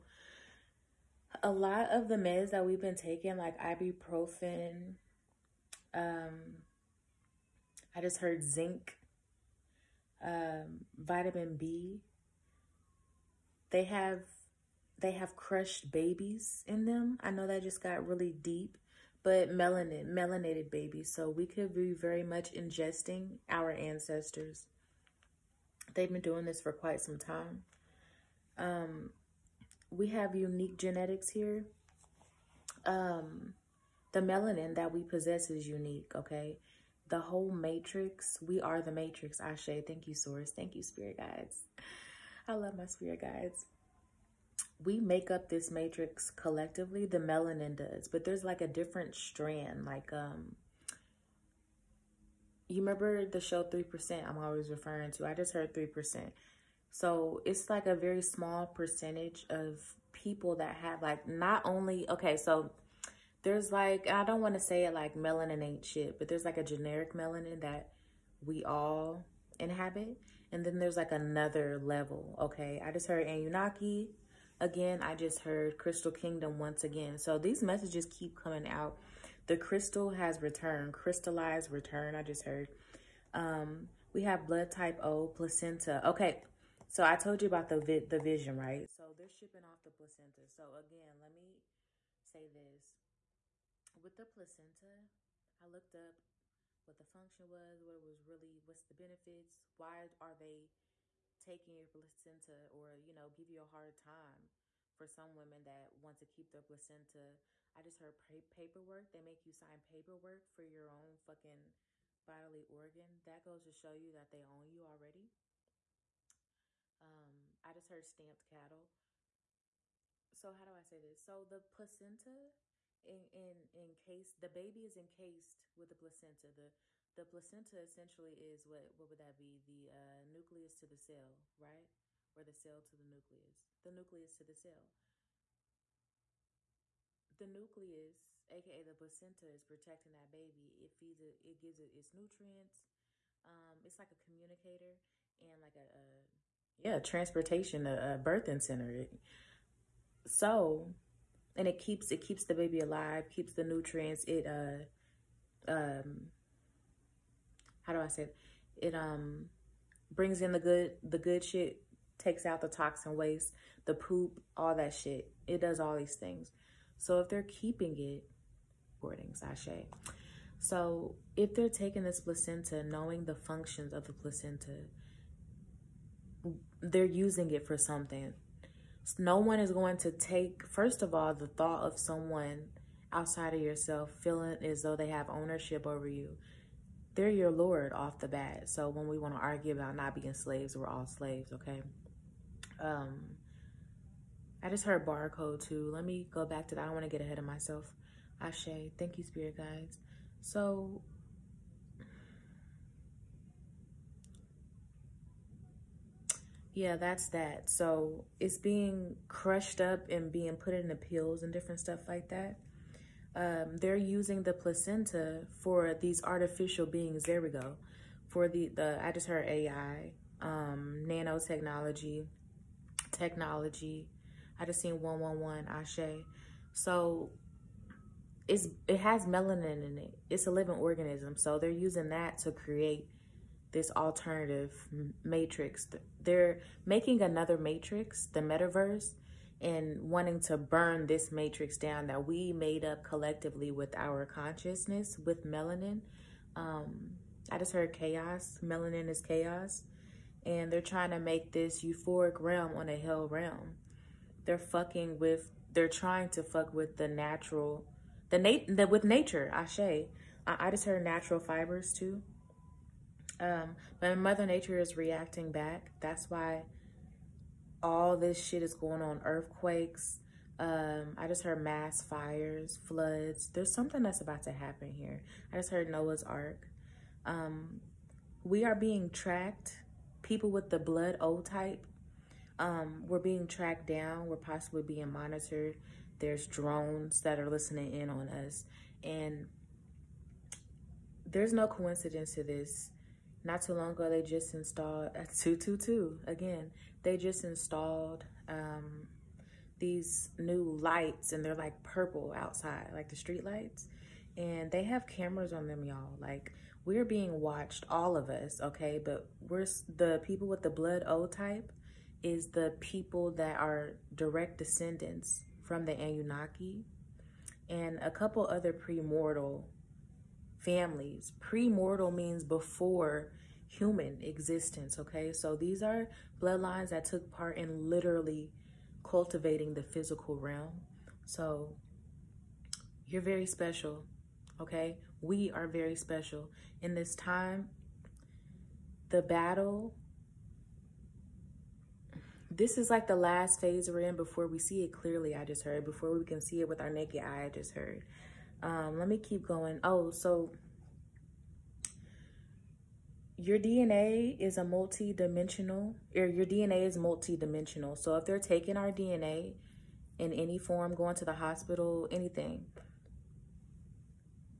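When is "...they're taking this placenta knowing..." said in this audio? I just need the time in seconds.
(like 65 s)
171 s.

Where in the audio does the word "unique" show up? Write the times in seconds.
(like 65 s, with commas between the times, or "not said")
30 s, 35 s.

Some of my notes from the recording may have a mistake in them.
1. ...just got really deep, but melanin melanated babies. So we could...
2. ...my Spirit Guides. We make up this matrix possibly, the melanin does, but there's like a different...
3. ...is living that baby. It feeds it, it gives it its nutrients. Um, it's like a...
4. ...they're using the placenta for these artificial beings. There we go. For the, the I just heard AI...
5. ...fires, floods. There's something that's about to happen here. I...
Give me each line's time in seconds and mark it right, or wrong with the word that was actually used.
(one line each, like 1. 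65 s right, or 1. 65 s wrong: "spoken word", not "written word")
1. 17 s right
2. 42 s wrong: "collectively", not "possibly"
3. 139 s wrong: "protecting", not "living"
4. 213 s right
5. 272 s right.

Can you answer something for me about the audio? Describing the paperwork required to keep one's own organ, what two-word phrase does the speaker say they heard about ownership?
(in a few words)
stamped cattle.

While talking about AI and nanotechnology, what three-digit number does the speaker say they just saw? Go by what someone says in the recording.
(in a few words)
111.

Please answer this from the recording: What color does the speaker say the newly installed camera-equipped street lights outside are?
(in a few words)
purple.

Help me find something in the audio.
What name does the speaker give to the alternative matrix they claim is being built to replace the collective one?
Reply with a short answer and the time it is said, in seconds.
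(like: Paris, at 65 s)
the metaverse, at 238 s.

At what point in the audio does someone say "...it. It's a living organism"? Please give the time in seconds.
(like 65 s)
229 s.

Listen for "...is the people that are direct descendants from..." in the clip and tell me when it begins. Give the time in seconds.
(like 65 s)
312 s.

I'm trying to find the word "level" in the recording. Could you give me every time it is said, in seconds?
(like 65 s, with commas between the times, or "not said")
71 s.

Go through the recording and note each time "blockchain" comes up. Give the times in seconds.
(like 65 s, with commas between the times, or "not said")
not said.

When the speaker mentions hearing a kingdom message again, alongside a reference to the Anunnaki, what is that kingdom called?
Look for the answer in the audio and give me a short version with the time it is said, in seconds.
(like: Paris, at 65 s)
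Crystal Kingdom, at 75 s.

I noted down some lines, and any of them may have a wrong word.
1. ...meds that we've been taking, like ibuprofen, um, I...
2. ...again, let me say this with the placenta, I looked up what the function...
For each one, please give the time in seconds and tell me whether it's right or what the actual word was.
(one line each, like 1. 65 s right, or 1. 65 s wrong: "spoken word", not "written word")
1. 2 s right
2. 90 s right.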